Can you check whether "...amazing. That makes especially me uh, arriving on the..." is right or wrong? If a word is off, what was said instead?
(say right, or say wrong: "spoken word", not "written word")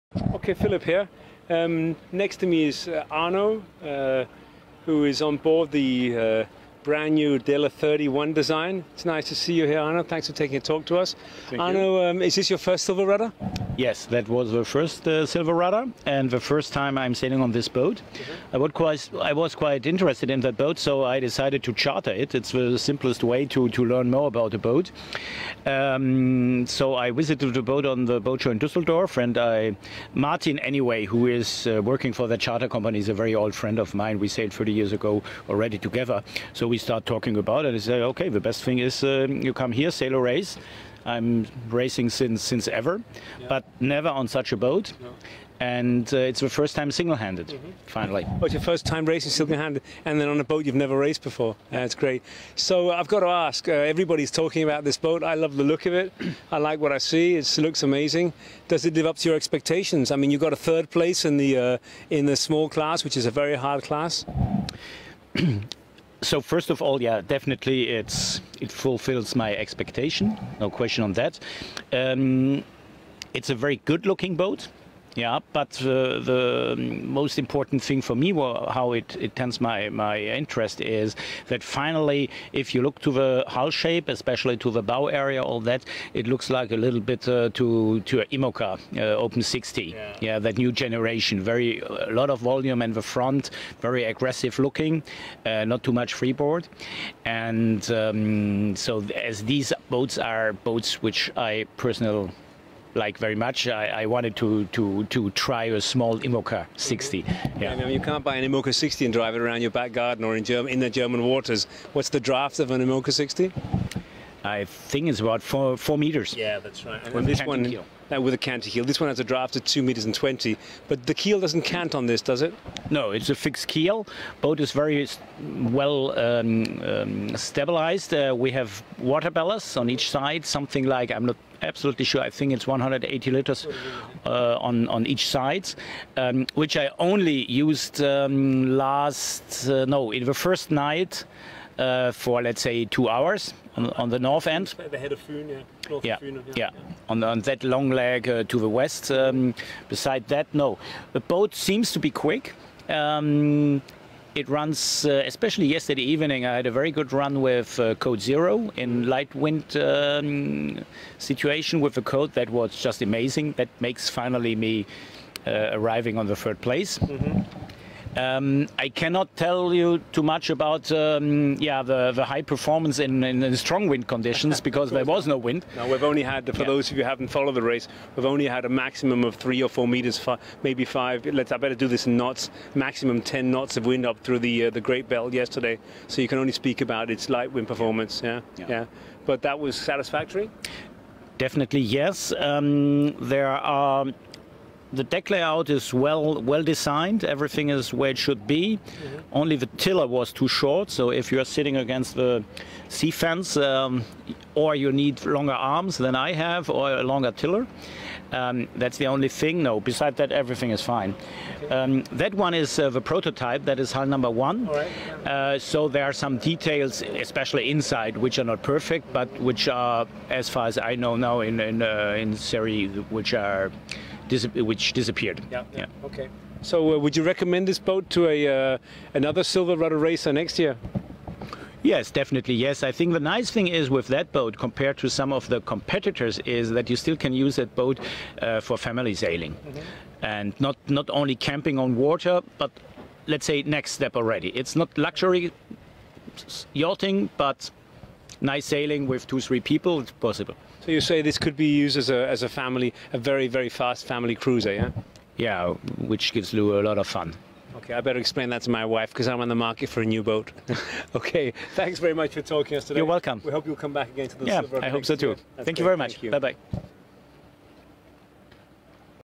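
wrong: "finally", not "especially".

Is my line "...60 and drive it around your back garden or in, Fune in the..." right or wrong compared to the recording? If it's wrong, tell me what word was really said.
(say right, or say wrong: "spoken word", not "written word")
wrong: "Germ", not "Fune".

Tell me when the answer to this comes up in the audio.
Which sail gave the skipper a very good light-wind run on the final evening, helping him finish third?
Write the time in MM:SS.
02:37.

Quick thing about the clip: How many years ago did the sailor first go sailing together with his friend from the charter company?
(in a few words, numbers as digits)
30.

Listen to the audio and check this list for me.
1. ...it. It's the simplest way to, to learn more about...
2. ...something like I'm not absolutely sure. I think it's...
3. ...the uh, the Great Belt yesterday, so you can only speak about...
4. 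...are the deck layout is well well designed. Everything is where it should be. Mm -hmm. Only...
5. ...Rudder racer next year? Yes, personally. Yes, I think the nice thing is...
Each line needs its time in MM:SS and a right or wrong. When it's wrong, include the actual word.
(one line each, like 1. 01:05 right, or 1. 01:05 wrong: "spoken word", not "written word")
1. 00:22 right
2. 02:10 right
3. 03:04 right
4. 03:13 right
5. 03:49 wrong: "definitely", not "personally".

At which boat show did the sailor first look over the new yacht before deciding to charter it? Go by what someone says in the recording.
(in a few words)
Dusseldorf.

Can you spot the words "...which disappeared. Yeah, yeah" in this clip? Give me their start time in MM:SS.
03:44.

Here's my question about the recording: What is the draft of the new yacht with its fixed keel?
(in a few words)
2.20 meters.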